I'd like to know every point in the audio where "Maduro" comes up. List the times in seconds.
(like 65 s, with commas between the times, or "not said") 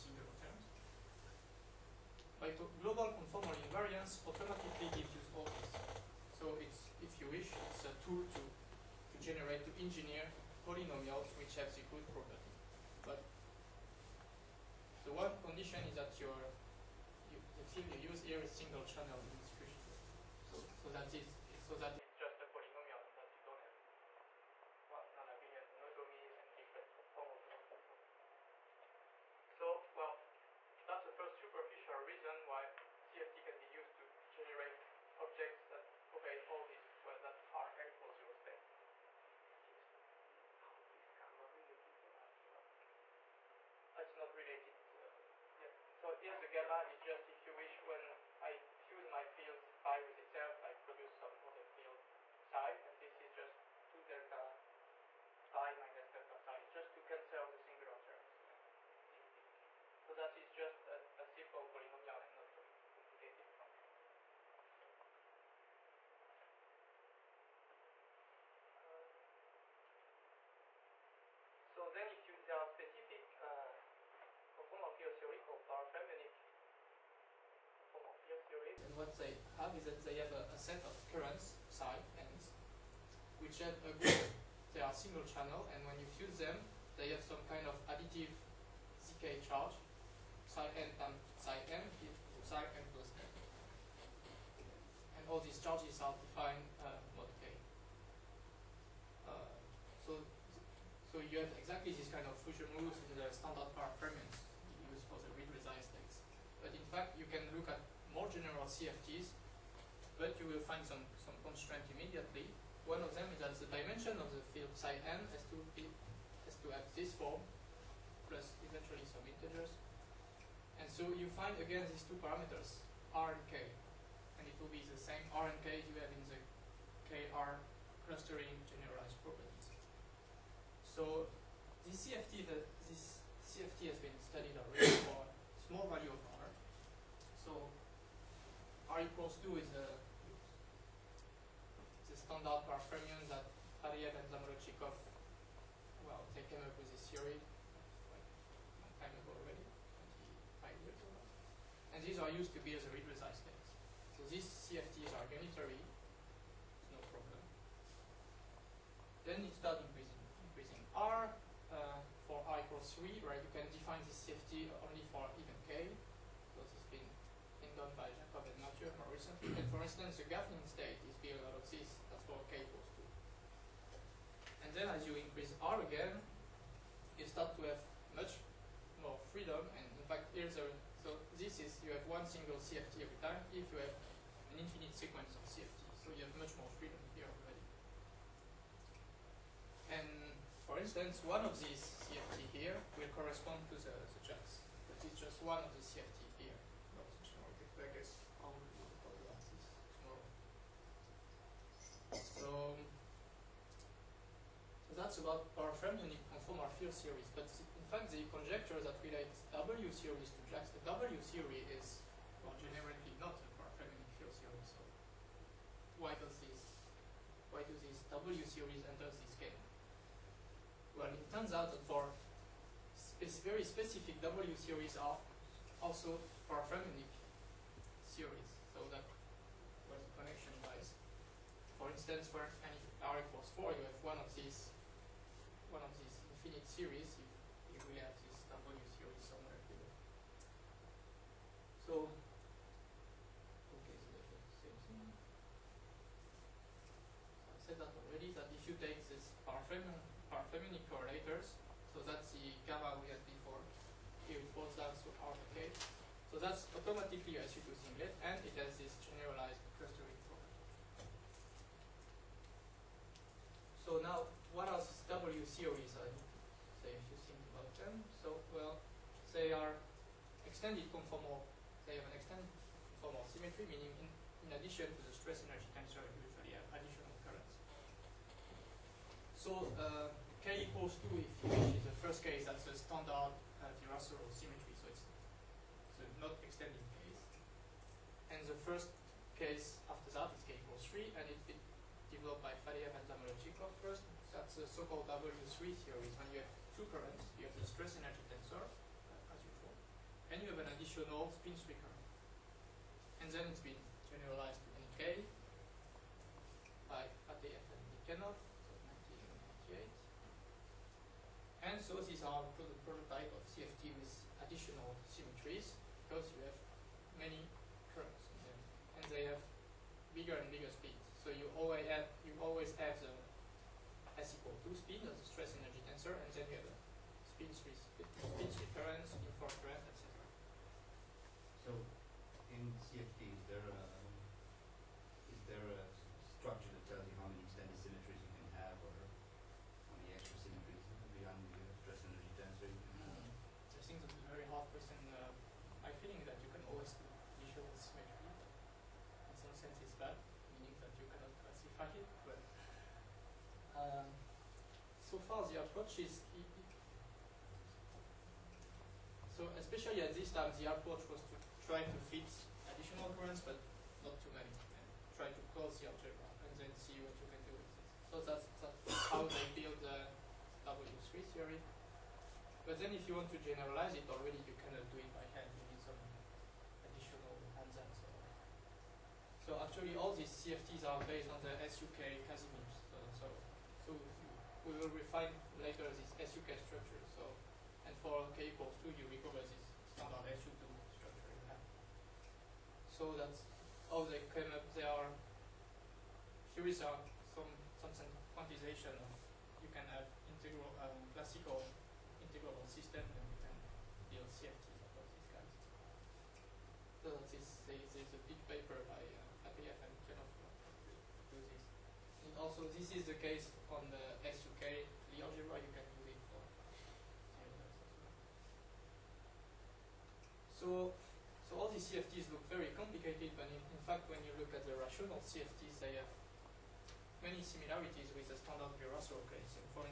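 not said.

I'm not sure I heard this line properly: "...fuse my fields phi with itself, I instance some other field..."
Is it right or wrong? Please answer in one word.
wrong.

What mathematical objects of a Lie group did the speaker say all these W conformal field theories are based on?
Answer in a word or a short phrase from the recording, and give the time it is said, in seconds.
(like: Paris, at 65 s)
SU(k) Casimirs, at 381 s.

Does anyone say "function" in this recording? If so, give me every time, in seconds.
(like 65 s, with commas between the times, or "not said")
63 s.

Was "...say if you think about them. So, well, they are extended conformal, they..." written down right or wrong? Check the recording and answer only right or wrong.
right.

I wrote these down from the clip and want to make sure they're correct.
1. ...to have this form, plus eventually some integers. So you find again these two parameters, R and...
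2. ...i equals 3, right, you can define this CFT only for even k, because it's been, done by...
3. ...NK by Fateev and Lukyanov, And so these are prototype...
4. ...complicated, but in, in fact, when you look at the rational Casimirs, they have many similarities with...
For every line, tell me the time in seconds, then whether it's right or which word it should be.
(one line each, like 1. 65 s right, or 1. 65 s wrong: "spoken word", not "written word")
1. 116 s right
2. 162 s right
3. 304 s right
4. 422 s wrong: "CFTs", not "Casimirs".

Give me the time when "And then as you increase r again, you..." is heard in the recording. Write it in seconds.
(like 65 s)
174 s.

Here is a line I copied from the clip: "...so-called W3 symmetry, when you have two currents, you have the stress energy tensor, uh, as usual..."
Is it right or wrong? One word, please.
wrong.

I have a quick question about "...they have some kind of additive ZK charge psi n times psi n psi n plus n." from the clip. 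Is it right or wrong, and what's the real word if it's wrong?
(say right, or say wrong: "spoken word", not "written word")
right.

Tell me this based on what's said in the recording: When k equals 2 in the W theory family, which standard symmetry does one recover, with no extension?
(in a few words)
Virasoro symmetry.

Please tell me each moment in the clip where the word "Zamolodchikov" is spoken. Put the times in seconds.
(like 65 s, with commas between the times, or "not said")
144 s, 293 s.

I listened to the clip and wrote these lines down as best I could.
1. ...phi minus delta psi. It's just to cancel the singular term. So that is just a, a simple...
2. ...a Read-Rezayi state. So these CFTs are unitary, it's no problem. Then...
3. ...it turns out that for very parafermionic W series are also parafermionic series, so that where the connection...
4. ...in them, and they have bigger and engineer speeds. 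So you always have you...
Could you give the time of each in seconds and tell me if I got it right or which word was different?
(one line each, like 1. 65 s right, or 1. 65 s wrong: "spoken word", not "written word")
1. 55 s right
2. 152 s right
3. 221 s wrong: "specific", not "parafermionic"
4. 318 s wrong: "bigger", not "engineer".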